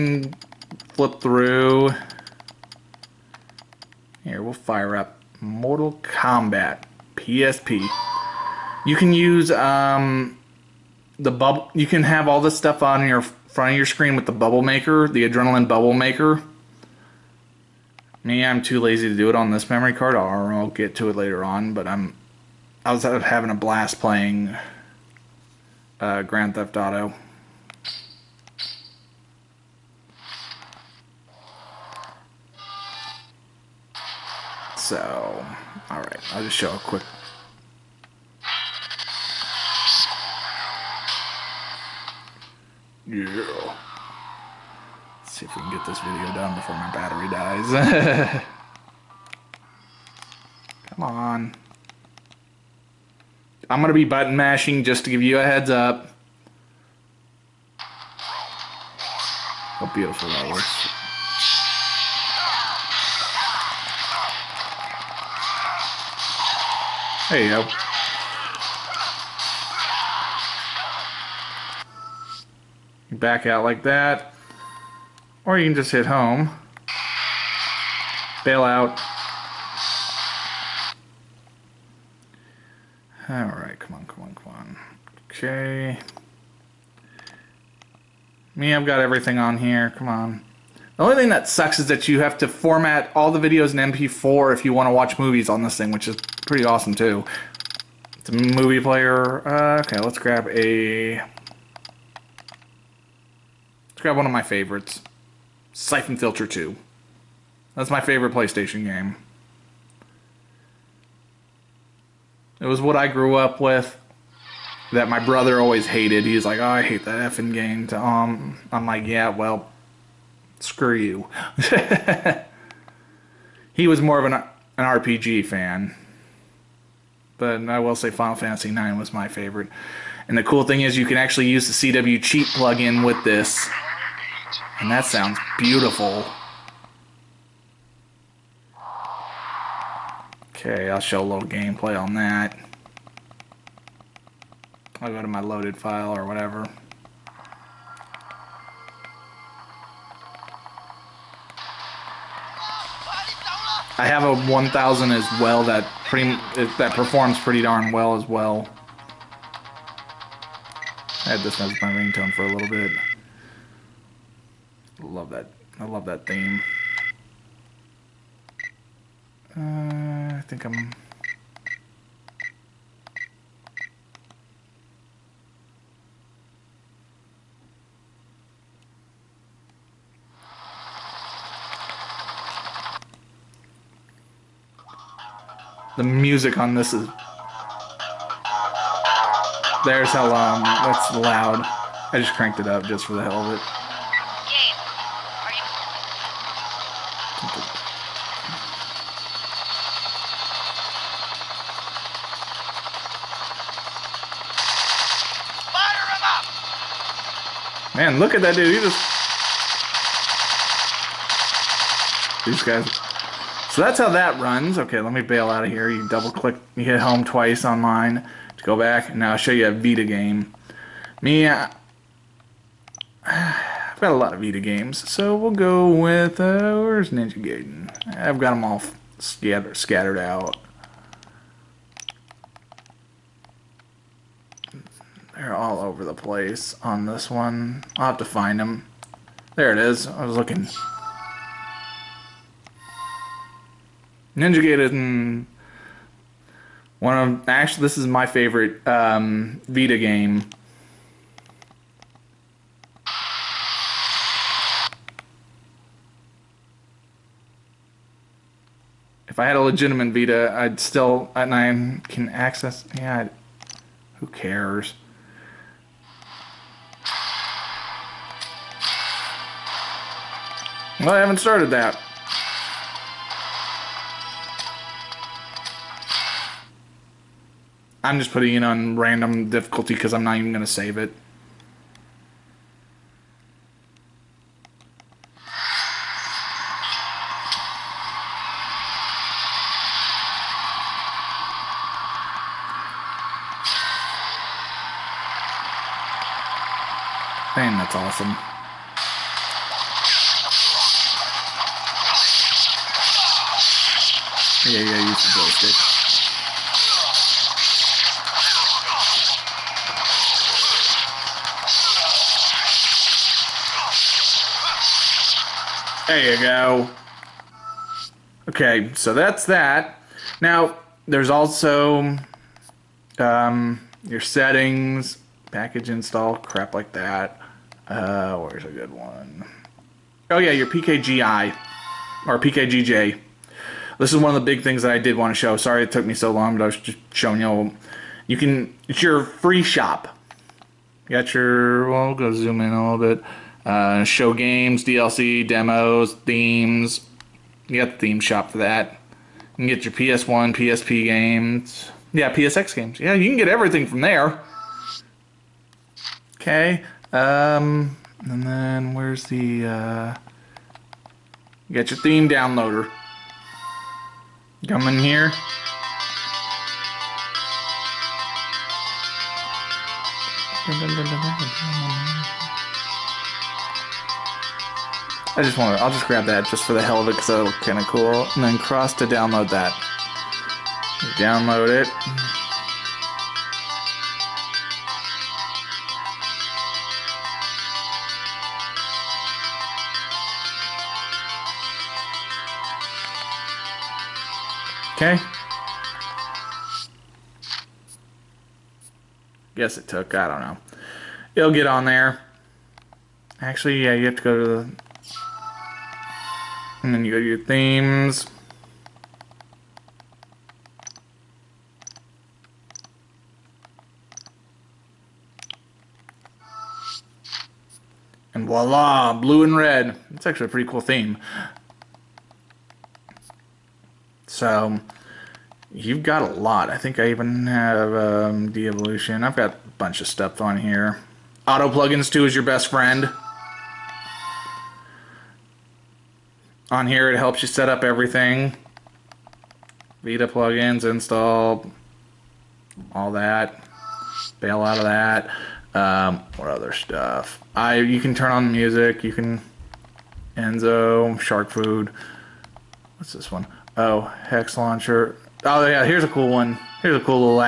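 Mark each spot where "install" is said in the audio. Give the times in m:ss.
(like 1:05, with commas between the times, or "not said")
5:25, 7:20.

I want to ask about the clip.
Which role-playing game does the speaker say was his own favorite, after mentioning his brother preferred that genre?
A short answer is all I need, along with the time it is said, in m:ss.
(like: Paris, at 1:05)
Final Fantasy IX, at 2:08.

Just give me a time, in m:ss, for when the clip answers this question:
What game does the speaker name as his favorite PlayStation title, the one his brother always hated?
1:45.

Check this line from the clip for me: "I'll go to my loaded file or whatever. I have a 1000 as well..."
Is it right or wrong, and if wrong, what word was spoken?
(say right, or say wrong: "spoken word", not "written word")
right.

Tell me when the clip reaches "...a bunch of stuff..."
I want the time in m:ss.
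7:09.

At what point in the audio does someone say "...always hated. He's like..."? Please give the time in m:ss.
1:55.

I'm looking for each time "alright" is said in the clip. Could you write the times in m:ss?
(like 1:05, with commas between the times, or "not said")
0:35, 1:23.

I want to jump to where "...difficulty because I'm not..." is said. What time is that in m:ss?
4:39.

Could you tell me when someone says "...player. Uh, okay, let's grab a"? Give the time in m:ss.
1:38.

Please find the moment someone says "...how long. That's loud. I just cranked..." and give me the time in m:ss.
3:10.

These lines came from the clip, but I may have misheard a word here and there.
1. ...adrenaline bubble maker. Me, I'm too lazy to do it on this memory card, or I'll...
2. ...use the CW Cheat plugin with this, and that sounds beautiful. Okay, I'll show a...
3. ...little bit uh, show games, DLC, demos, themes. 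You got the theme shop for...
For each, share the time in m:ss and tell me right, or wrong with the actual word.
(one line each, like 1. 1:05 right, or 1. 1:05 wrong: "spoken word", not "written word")
1. 0:15 right
2. 2:11 right
3. 5:42 right.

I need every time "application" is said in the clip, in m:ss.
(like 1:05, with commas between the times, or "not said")
not said.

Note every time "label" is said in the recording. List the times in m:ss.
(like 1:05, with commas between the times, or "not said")
not said.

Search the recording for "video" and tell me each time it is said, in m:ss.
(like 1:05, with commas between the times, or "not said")
0:45, 1:33.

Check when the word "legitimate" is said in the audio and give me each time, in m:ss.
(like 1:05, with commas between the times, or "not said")
4:19.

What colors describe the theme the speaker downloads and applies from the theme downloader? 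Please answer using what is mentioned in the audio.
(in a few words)
blue and red.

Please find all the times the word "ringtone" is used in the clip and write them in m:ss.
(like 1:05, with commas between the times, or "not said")
2:41.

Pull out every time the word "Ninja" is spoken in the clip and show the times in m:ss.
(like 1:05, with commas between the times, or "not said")
3:47, 4:04.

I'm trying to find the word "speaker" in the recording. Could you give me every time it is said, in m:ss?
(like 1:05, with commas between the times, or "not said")
not said.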